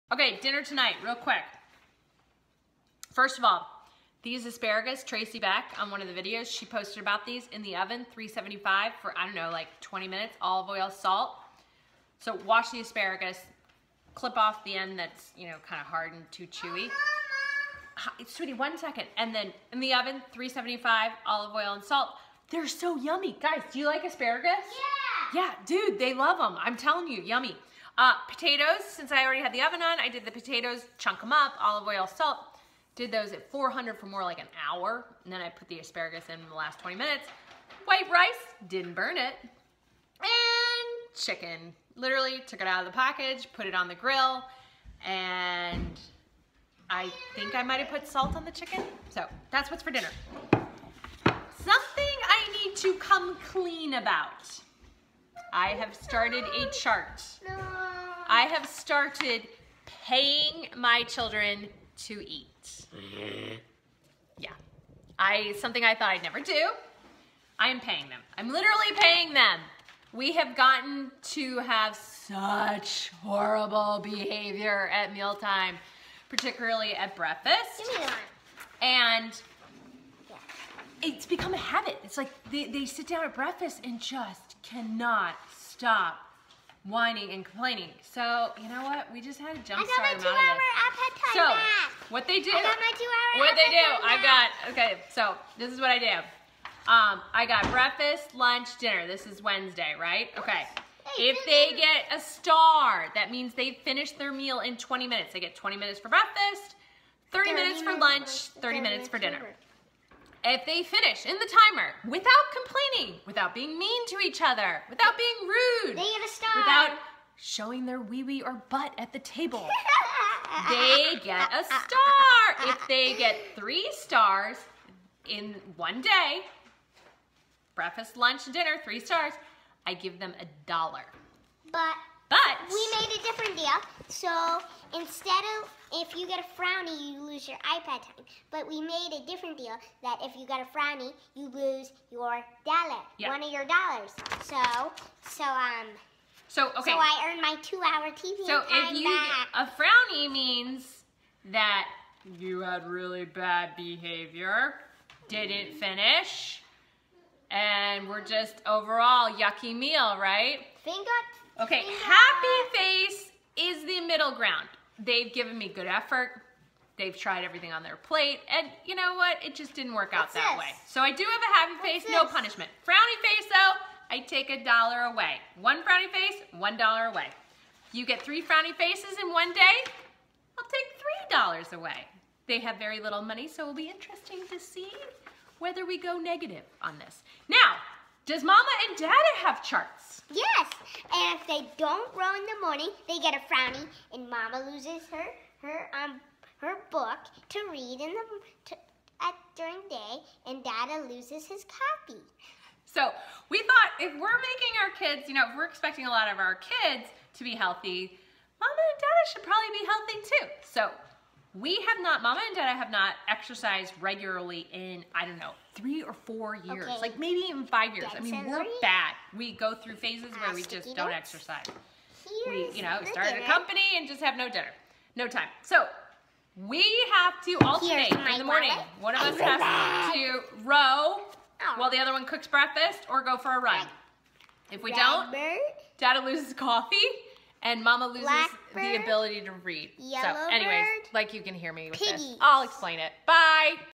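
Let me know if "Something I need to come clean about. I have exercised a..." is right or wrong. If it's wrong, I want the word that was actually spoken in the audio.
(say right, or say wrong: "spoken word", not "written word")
wrong: "started", not "exercised".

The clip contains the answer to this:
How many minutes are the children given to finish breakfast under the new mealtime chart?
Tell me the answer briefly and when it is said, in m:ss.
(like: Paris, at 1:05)
20 minutes, at 1:45.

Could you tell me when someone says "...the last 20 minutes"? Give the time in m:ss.
0:36.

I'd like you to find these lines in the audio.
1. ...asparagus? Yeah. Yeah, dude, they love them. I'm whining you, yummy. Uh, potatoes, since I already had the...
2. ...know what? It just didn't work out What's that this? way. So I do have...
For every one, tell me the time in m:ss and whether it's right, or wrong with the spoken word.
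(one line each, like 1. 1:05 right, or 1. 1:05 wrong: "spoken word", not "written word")
1. 0:24 wrong: "telling", not "whining"
2. 2:48 right.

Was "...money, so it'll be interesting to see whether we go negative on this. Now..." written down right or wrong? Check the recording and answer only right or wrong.
right.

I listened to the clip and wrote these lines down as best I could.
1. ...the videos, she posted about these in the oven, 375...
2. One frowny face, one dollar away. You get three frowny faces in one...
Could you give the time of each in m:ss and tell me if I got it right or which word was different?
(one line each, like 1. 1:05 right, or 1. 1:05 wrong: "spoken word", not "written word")
1. 0:06 right
2. 2:55 right.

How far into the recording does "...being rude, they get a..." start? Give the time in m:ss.
1:55.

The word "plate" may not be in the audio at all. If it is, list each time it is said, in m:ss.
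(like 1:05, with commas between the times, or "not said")
2:47.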